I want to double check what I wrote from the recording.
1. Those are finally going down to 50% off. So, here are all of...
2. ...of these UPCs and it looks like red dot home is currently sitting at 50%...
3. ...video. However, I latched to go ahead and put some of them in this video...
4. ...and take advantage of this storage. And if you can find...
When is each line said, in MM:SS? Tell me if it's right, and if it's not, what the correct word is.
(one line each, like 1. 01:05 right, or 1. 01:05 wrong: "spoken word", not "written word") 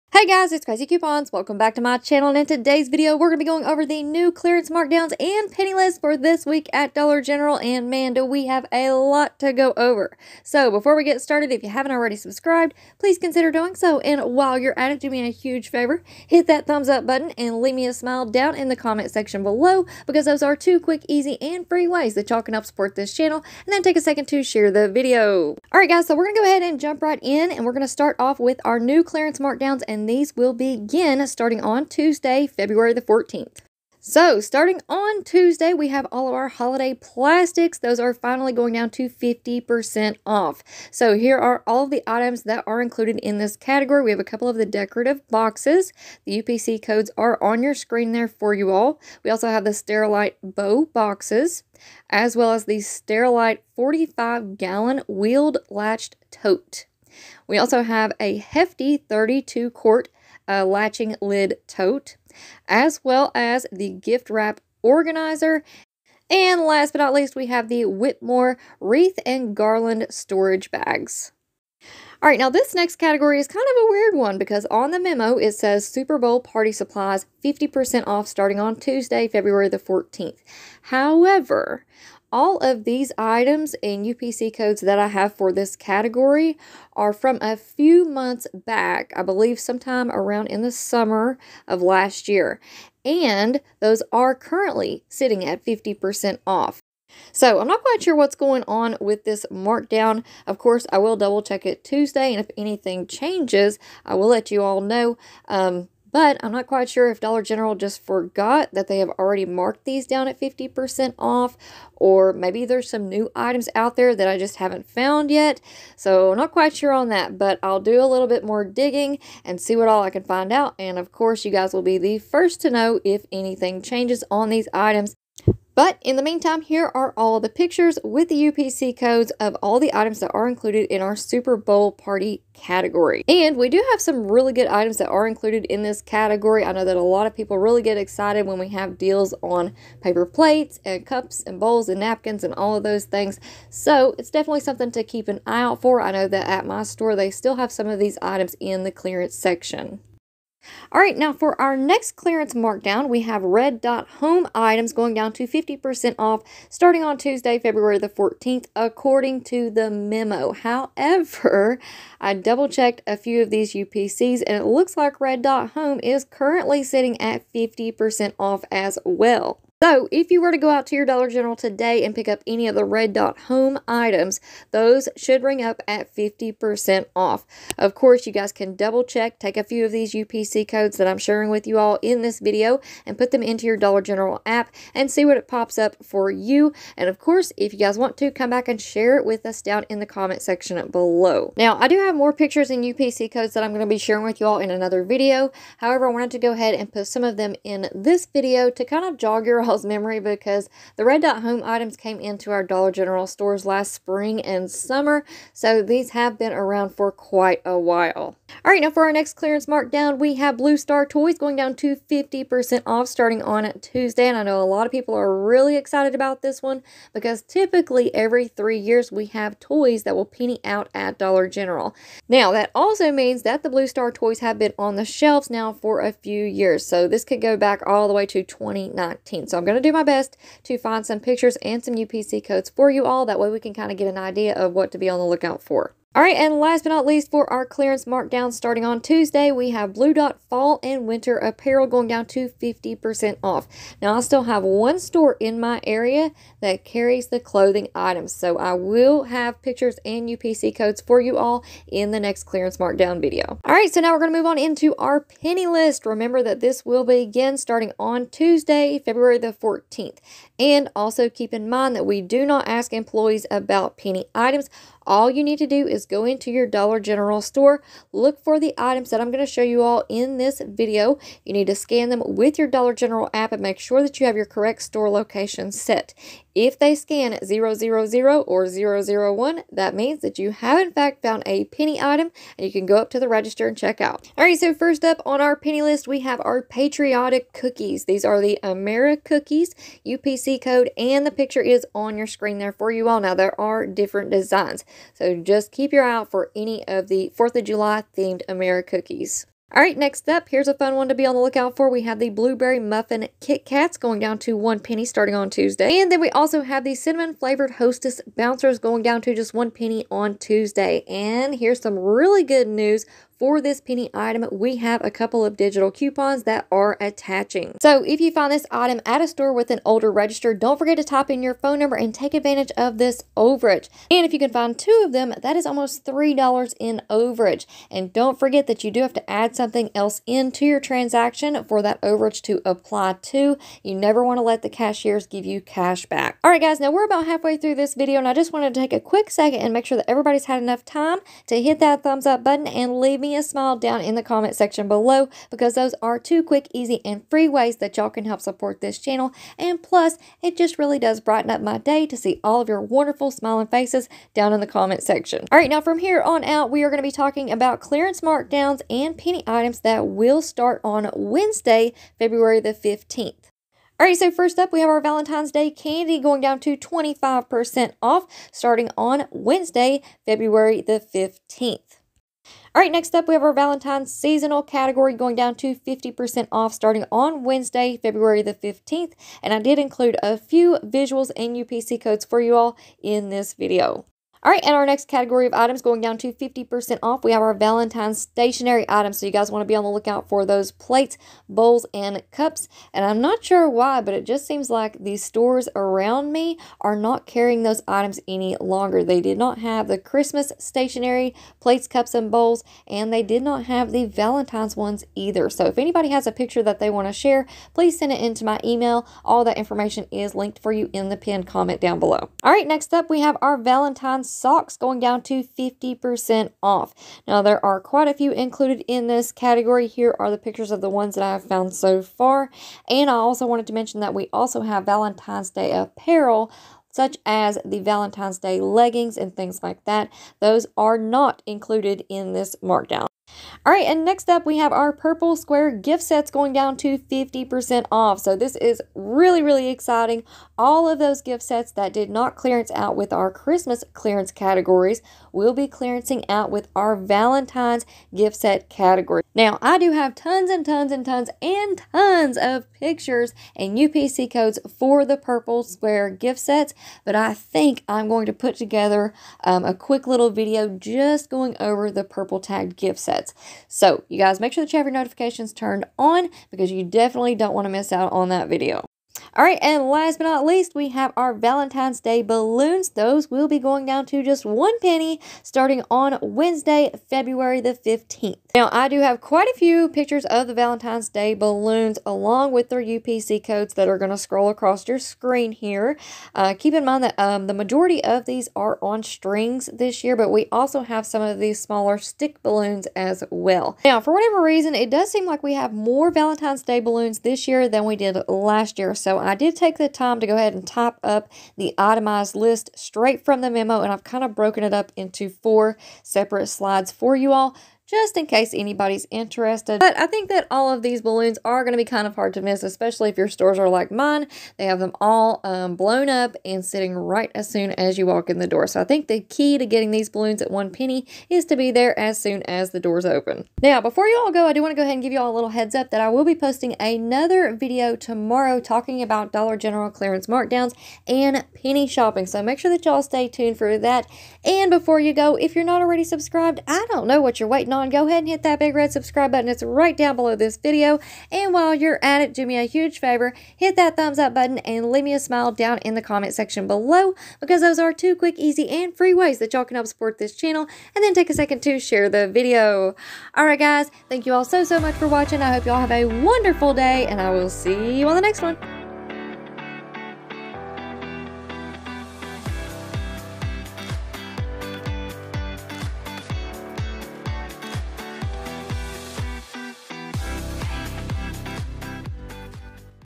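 1. 00:37 right
2. 02:43 right
3. 03:15 wrong: "wanted", not "latched"
4. 05:21 wrong: "overage", not "storage".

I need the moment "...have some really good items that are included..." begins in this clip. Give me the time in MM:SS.
02:13.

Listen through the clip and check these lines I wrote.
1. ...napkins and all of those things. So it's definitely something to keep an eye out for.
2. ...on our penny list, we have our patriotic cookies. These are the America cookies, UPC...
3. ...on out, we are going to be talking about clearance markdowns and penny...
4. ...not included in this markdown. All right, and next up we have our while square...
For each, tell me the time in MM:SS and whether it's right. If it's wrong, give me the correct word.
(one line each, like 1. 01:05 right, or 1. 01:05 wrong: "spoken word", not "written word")
1. 02:22 right
2. 04:45 right
3. 05:56 right
4. 07:10 wrong: "purple", not "while".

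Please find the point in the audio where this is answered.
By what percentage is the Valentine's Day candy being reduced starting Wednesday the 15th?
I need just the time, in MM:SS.
06:06.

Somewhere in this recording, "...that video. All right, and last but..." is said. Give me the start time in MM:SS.
07:48.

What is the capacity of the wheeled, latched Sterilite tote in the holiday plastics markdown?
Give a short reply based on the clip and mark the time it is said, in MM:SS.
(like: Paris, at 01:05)
45 gallon, at 00:53.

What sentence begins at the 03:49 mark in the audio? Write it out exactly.
So I'm going to do my best to find some pictures and some UPC codes for you all.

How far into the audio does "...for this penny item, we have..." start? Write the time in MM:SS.
05:13.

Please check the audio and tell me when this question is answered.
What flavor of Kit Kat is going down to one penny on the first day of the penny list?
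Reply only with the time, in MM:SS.
05:02.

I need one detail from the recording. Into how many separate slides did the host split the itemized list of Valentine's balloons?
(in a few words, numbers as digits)
4.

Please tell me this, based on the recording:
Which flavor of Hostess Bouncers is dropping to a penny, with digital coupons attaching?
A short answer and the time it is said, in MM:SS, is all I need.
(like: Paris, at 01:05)
Cinnamon, at 05:06.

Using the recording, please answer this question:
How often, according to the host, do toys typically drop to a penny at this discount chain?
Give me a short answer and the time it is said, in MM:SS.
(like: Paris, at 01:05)
every three years, at 03:38.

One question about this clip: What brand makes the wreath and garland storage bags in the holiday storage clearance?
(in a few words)
Whitmor.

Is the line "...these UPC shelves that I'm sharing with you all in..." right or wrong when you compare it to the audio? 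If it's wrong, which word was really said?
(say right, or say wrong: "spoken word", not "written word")
wrong: "codes", not "shelves".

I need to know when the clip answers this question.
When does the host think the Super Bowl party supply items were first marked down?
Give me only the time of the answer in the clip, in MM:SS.
01:30.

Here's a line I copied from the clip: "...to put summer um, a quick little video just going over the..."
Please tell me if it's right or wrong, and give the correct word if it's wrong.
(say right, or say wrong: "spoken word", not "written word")
wrong: "together", not "summer".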